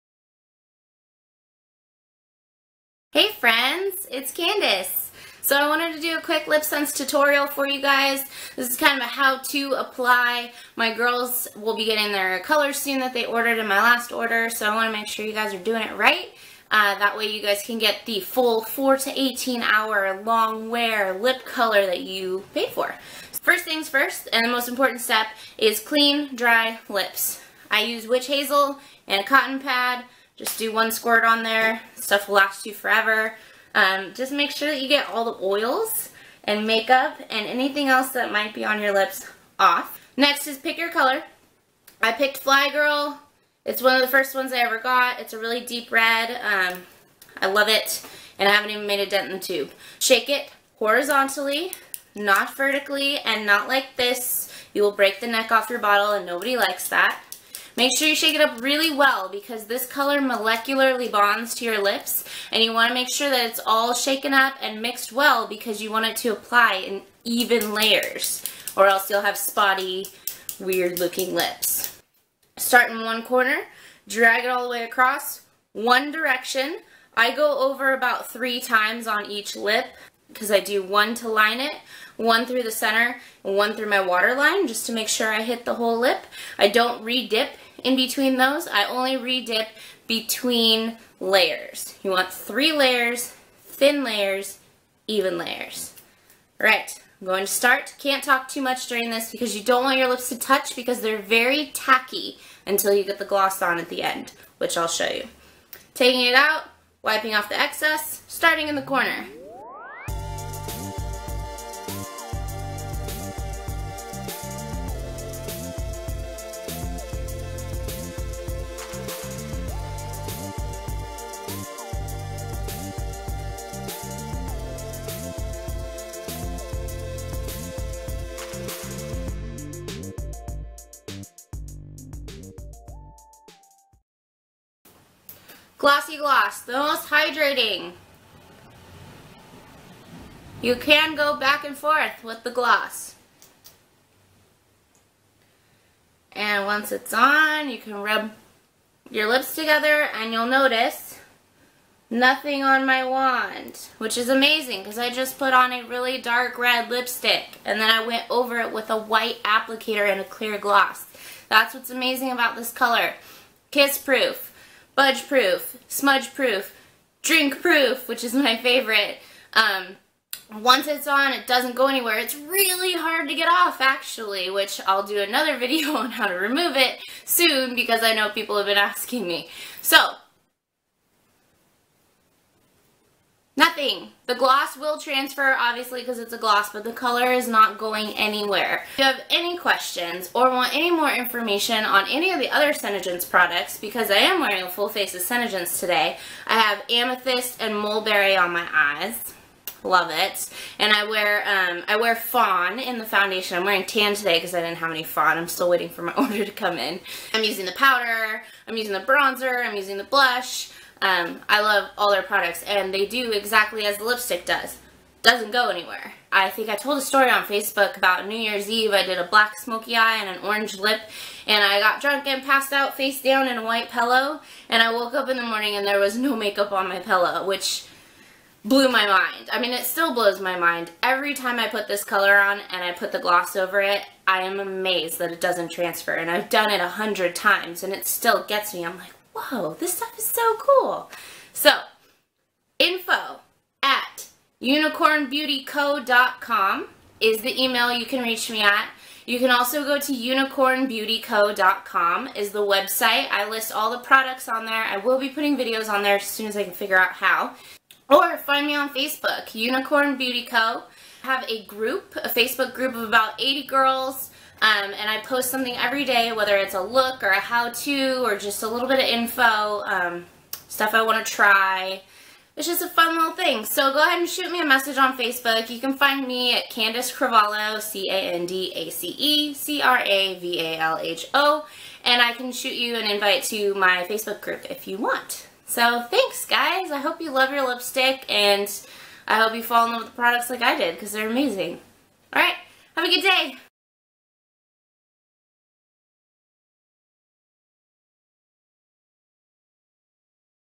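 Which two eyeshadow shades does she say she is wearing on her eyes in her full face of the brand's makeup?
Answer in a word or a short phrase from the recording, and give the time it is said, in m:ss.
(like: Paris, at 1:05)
Amethyst and mulberry, at 3:16.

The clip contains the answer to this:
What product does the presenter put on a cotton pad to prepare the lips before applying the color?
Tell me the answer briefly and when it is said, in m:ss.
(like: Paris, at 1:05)
Witch hazel, at 0:28.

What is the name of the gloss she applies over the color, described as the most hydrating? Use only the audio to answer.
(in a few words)
Glossy Gloss.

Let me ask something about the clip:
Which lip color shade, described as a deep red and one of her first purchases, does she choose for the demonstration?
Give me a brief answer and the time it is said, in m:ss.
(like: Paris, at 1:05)
Fly Girl, at 0:42.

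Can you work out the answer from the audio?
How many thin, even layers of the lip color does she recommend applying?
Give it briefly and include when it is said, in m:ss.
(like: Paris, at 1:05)
3, at 1:32.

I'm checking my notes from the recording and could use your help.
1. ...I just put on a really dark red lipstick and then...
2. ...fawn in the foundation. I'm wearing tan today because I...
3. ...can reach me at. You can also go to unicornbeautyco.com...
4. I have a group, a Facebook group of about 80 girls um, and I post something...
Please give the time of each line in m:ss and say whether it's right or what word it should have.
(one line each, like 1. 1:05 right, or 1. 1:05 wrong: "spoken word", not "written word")
1. 2:34 right
2. 3:22 right
3. 4:08 right
4. 4:21 right.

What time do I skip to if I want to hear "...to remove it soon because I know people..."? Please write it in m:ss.
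2:56.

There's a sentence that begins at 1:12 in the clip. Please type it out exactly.
Start in one corner, drag it all the way across, one direction.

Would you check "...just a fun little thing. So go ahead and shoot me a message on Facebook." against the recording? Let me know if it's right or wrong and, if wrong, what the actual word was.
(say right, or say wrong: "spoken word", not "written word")
right.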